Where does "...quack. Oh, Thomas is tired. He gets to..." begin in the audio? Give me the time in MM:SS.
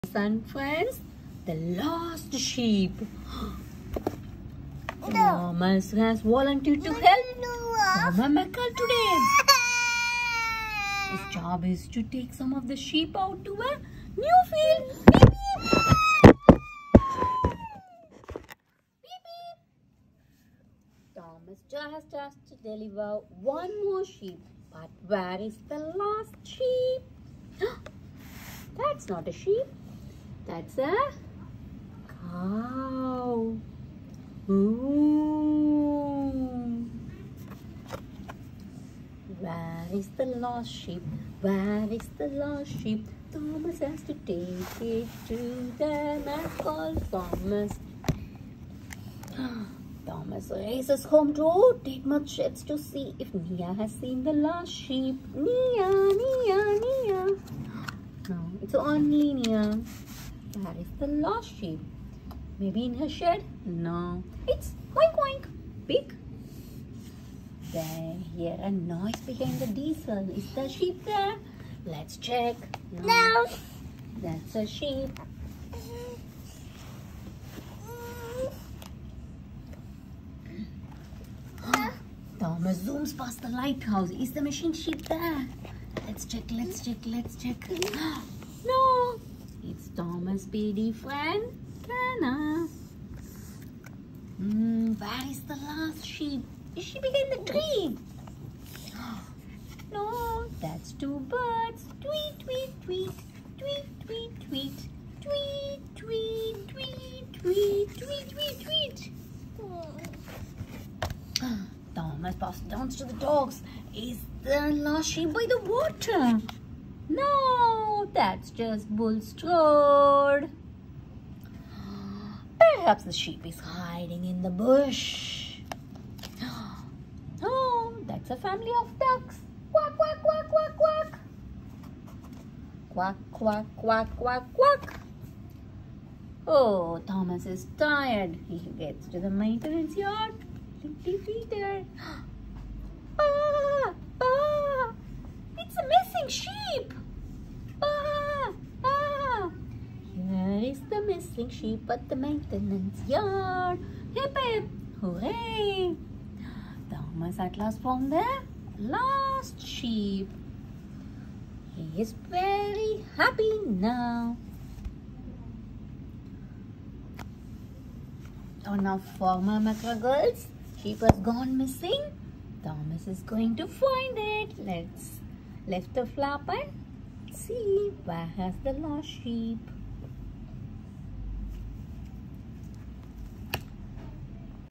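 02:14.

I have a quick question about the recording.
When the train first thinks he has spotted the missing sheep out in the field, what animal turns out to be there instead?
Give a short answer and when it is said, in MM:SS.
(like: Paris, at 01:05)
A cow, at 00:30.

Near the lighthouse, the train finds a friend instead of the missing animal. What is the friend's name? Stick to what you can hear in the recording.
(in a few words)
Fontana.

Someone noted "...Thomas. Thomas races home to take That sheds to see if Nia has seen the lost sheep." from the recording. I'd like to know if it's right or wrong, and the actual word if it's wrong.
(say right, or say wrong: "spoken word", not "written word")
wrong: "Tidmouth", not "That".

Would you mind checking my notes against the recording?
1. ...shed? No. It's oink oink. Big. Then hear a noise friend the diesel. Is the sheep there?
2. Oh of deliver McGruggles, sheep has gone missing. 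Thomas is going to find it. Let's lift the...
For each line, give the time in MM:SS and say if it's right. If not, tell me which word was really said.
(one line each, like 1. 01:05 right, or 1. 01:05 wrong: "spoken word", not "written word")
1. 01:03 wrong: "behind", not "friend"
2. 02:48 wrong: "former", not "deliver".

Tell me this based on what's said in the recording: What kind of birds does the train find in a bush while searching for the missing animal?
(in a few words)
Ducks.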